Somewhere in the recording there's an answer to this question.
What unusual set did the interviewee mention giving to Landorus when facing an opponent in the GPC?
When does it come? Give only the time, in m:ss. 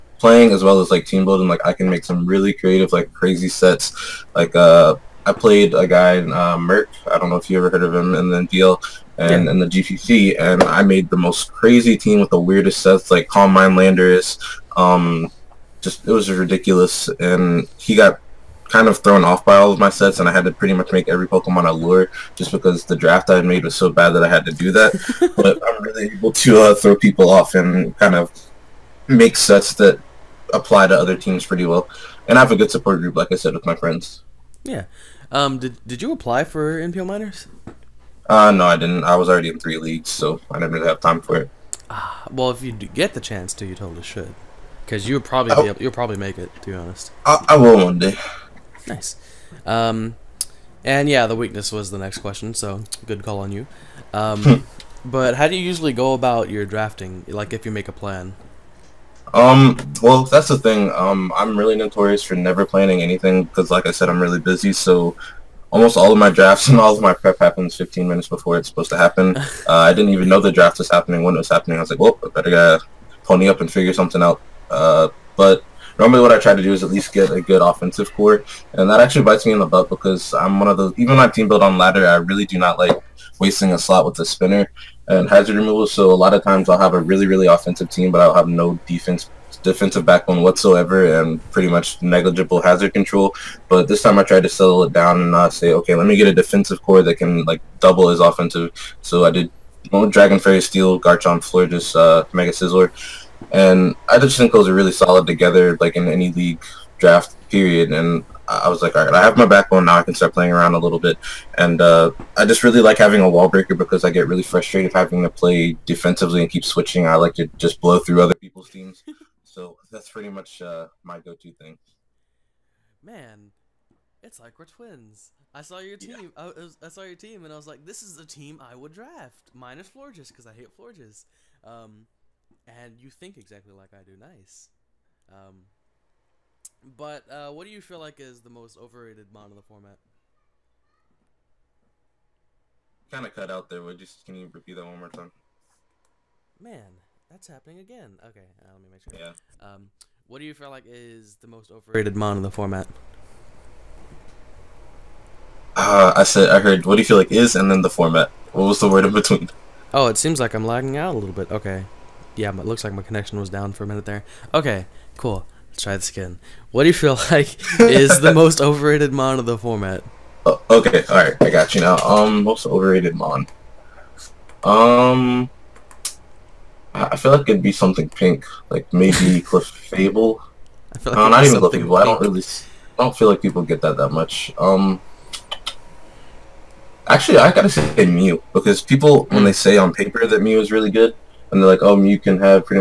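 0:13.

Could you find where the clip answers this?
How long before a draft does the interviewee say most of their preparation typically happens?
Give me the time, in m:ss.
1:07.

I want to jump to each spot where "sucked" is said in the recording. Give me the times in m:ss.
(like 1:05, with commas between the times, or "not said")
not said.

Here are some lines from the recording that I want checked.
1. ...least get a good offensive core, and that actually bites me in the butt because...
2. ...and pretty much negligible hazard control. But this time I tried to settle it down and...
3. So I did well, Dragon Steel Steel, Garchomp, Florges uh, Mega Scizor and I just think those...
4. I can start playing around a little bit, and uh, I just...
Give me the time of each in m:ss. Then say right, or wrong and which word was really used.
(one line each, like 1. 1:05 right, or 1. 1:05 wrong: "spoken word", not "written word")
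1. 1:16 right
2. 1:31 right
3. 1:39 wrong: "Fairy", not "Steel"
4. 1:49 right.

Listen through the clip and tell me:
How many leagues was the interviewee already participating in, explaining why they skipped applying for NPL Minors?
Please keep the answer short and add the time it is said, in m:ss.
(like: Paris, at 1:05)
3, at 0:39.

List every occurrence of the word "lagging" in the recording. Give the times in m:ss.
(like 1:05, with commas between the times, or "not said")
2:40.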